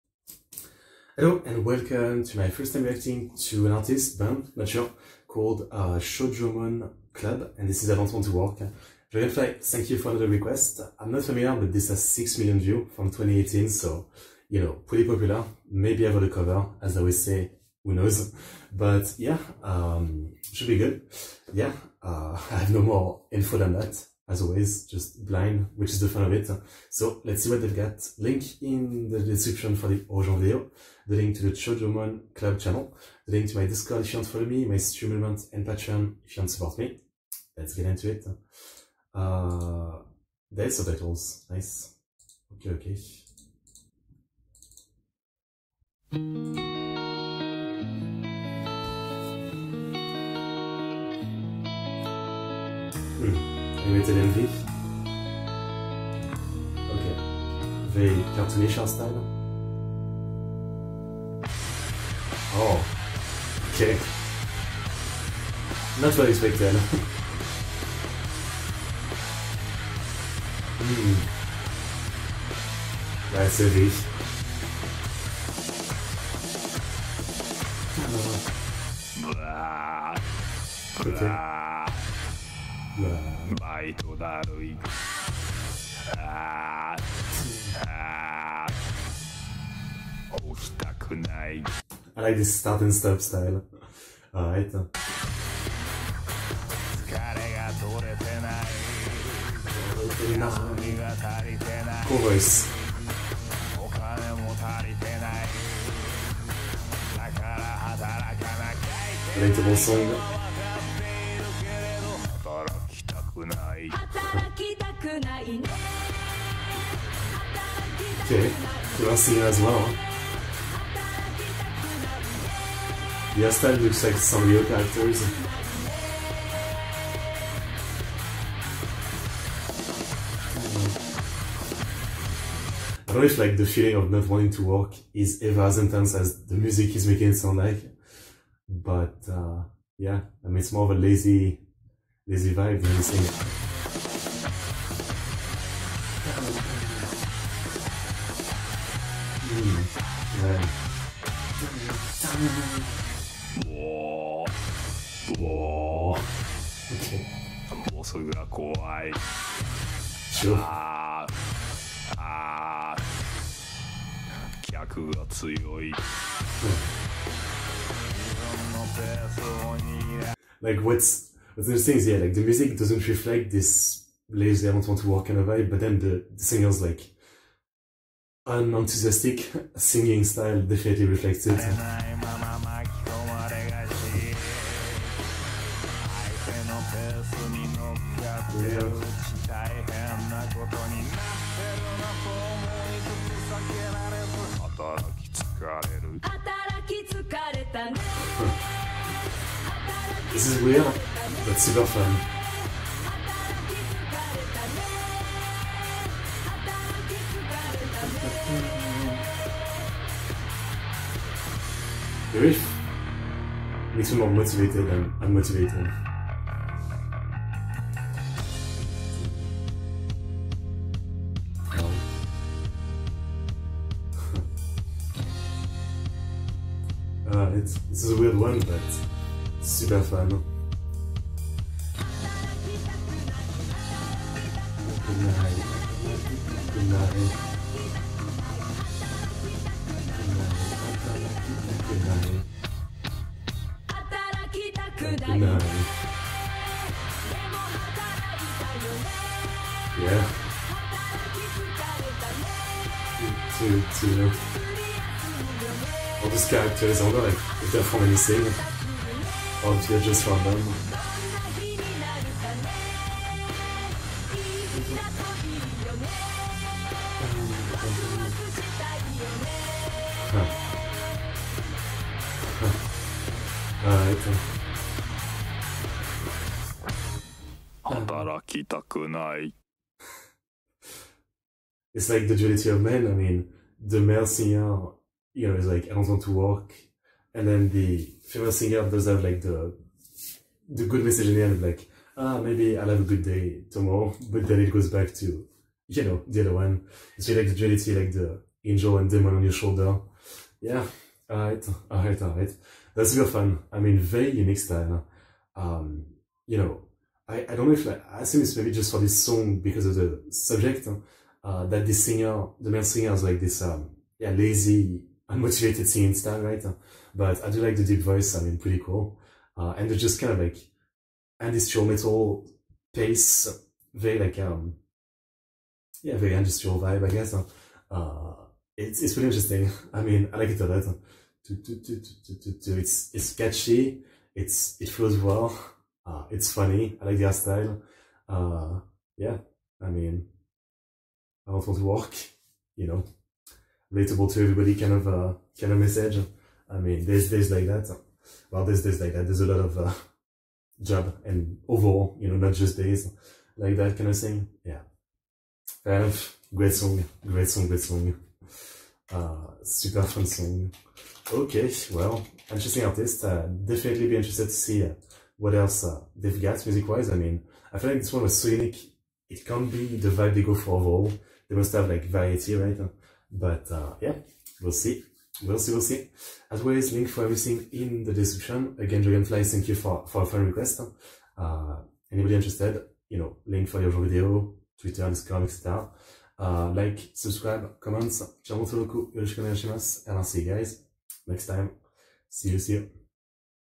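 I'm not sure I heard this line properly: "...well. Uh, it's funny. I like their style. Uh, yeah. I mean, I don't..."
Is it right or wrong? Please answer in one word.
right.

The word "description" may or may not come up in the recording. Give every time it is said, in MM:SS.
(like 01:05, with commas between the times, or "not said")
00:29, 06:18.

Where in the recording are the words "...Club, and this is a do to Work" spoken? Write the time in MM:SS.
00:07.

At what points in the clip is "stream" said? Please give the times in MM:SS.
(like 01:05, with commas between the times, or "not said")
00:34.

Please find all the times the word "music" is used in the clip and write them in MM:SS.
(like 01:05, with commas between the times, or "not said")
02:16, 02:52, 06:06.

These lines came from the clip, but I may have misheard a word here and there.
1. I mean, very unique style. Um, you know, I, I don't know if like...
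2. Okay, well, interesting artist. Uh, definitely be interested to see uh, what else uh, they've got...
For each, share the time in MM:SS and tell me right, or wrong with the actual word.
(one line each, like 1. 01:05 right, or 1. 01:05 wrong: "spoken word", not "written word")
1. 05:03 right
2. 06:01 right.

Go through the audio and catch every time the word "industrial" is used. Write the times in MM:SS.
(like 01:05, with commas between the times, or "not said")
05:21, 05:26.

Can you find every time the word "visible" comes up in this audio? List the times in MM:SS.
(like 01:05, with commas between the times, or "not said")
not said.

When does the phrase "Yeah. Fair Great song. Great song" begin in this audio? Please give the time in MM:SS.
05:54.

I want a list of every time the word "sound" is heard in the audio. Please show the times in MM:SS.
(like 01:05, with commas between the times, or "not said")
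02:17.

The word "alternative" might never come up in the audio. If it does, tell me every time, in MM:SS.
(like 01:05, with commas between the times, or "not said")
not said.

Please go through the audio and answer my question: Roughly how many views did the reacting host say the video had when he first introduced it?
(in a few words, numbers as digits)
6 million.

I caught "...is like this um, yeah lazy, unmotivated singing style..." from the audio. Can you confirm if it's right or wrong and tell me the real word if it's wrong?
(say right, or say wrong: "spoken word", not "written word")
right.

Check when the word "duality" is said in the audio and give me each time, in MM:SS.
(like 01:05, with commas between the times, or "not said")
04:42, 04:57.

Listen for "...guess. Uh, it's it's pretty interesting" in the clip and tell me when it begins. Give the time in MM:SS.
05:27.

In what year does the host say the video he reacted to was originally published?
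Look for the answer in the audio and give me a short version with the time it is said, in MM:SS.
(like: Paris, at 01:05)
2018, at 00:13.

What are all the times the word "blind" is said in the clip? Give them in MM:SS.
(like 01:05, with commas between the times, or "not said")
00:25.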